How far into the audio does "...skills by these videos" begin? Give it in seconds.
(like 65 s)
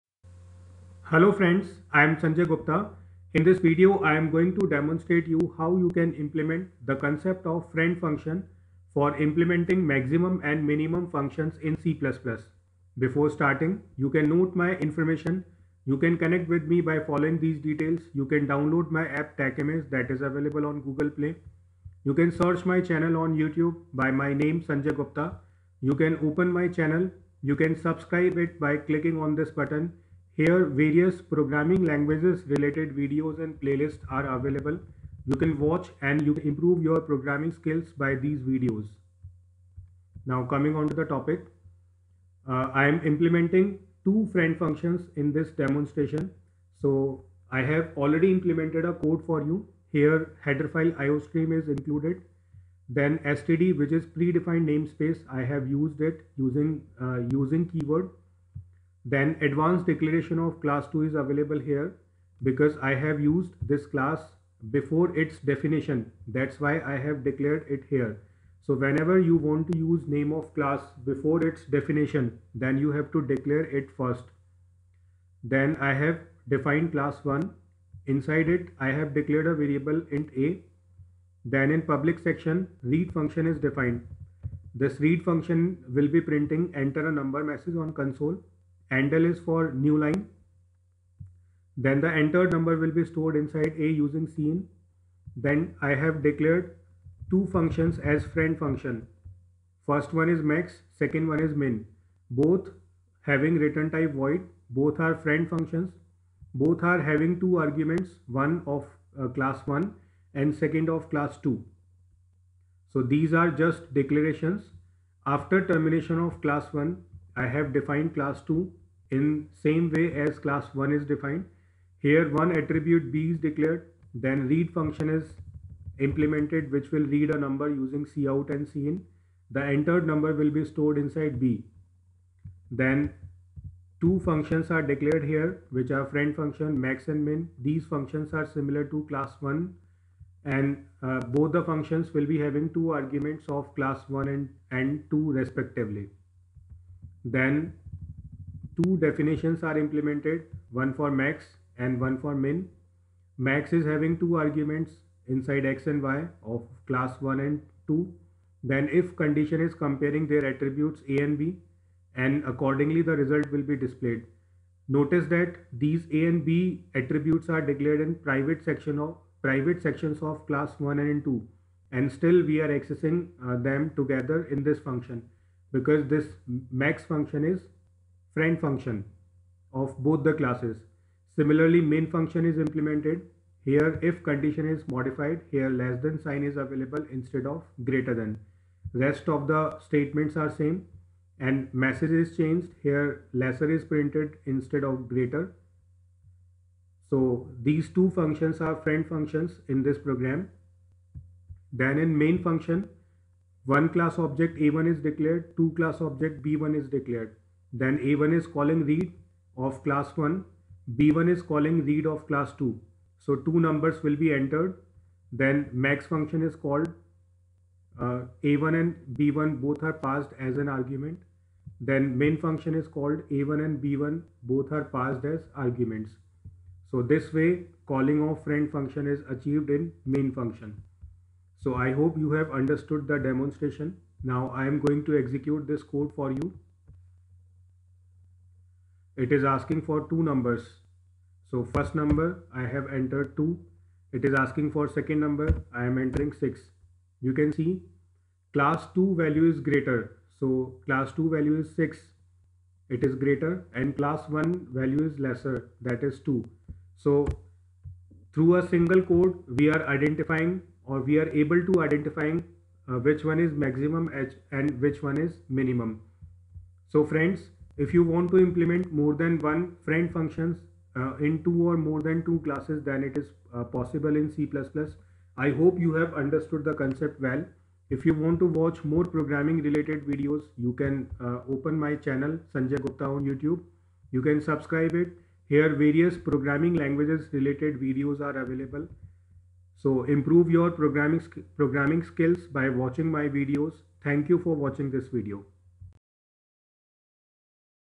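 37 s.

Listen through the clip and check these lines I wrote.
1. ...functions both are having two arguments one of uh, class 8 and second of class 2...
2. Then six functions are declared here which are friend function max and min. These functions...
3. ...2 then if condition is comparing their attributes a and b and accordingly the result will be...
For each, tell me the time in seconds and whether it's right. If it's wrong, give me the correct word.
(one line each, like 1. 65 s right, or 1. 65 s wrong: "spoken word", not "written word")
1. 105 s wrong: "1", not "8"
2. 132 s wrong: "two", not "six"
3. 157 s right.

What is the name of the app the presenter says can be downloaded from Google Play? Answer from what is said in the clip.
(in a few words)
TechMS.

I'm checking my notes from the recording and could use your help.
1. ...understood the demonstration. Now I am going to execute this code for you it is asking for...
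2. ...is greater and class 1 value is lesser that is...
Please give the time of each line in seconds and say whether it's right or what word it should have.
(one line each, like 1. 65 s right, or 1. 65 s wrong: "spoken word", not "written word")
1. 232 s right
2. 253 s right.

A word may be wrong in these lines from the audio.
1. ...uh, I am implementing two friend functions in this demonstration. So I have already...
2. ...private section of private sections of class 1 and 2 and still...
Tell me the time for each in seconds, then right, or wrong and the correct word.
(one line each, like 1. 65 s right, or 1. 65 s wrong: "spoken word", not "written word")
1. 42 s right
2. 168 s right.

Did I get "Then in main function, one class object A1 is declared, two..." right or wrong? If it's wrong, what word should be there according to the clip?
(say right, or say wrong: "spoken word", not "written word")
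right.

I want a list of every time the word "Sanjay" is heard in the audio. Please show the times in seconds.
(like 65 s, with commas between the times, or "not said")
2 s, 24 s, 282 s.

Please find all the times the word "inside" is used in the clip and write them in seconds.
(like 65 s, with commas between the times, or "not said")
78 s, 93 s, 130 s, 155 s.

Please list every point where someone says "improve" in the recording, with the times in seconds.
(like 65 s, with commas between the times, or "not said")
36 s, 290 s.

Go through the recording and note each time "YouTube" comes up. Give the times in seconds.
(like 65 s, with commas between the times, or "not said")
23 s, 283 s.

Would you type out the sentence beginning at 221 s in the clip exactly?
Then min function is called A1 and B1 both are passed as arguments.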